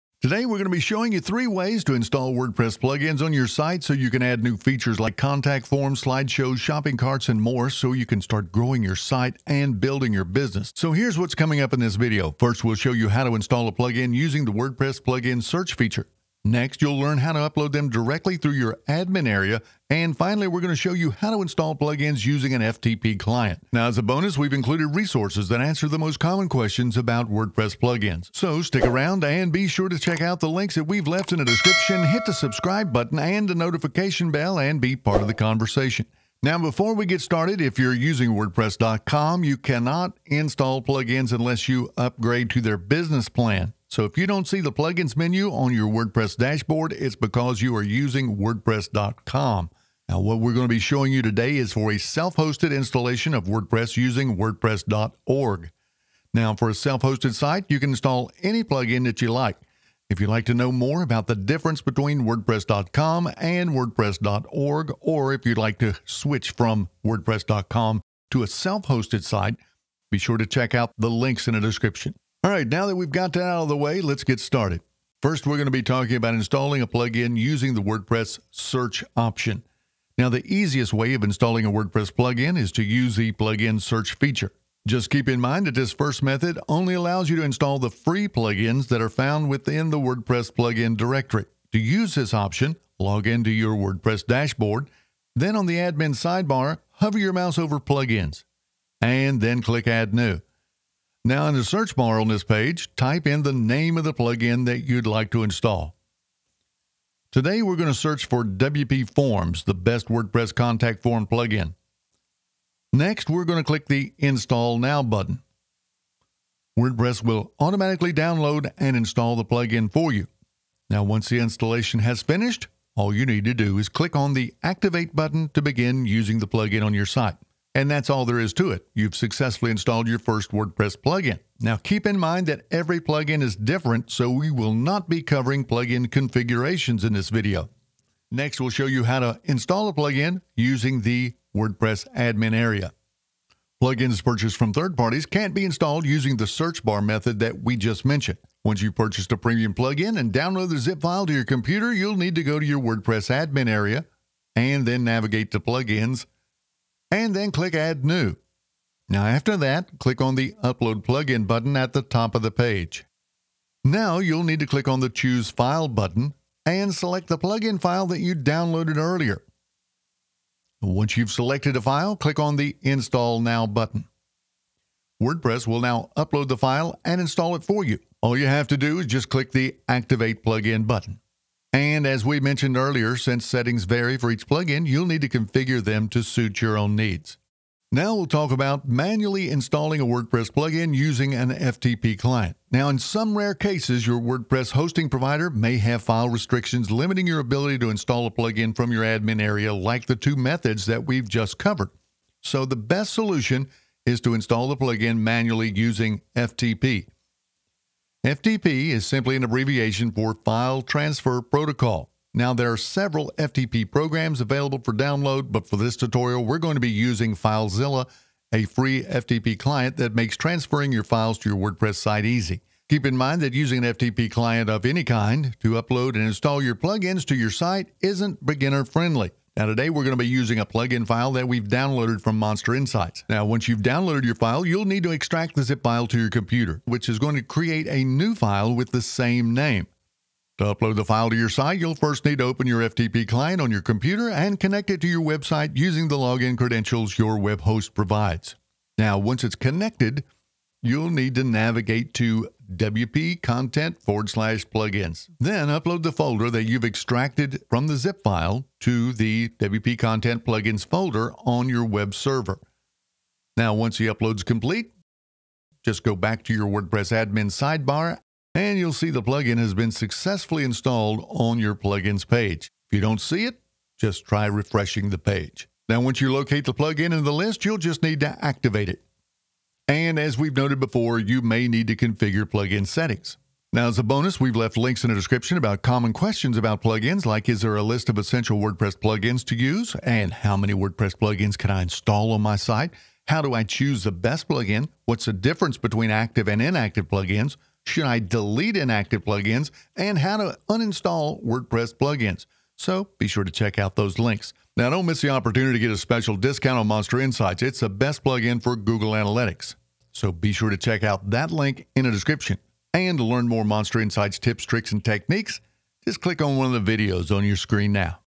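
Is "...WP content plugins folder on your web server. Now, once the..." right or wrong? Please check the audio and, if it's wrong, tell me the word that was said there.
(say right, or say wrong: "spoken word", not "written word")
right.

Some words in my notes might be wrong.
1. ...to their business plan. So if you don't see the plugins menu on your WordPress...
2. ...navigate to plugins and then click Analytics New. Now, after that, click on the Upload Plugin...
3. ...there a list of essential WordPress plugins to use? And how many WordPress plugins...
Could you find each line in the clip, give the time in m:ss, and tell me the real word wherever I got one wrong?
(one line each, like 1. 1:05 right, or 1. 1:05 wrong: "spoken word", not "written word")
1. 0:42 right
2. 2:35 wrong: "Add", not "Analytics"
3. 4:47 right.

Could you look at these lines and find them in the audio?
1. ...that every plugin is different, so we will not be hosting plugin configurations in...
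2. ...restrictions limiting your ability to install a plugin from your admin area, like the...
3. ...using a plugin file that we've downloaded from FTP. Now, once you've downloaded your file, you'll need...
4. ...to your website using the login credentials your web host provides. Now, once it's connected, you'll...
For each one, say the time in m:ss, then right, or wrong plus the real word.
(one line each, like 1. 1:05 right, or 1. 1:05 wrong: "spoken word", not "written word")
1. 2:12 wrong: "covering", not "hosting"
2. 3:16 right
3. 3:50 wrong: "MonsterInsights", not "FTP"
4. 4:05 right.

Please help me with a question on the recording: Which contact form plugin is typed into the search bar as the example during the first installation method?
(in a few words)
WPForms.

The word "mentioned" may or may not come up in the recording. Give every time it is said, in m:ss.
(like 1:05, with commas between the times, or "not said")
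2:28, 3:02.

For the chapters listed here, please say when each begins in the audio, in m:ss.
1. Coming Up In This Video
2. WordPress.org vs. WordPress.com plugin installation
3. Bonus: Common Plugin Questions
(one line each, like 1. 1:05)
1. 0:11
2. 0:39
3. 4:45.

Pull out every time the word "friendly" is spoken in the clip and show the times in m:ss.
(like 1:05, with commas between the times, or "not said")
3:48.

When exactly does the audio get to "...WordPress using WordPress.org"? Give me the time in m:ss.
0:53.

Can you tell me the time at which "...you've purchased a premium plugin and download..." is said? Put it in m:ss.
2:28.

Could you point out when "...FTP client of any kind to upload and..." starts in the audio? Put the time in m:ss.
3:43.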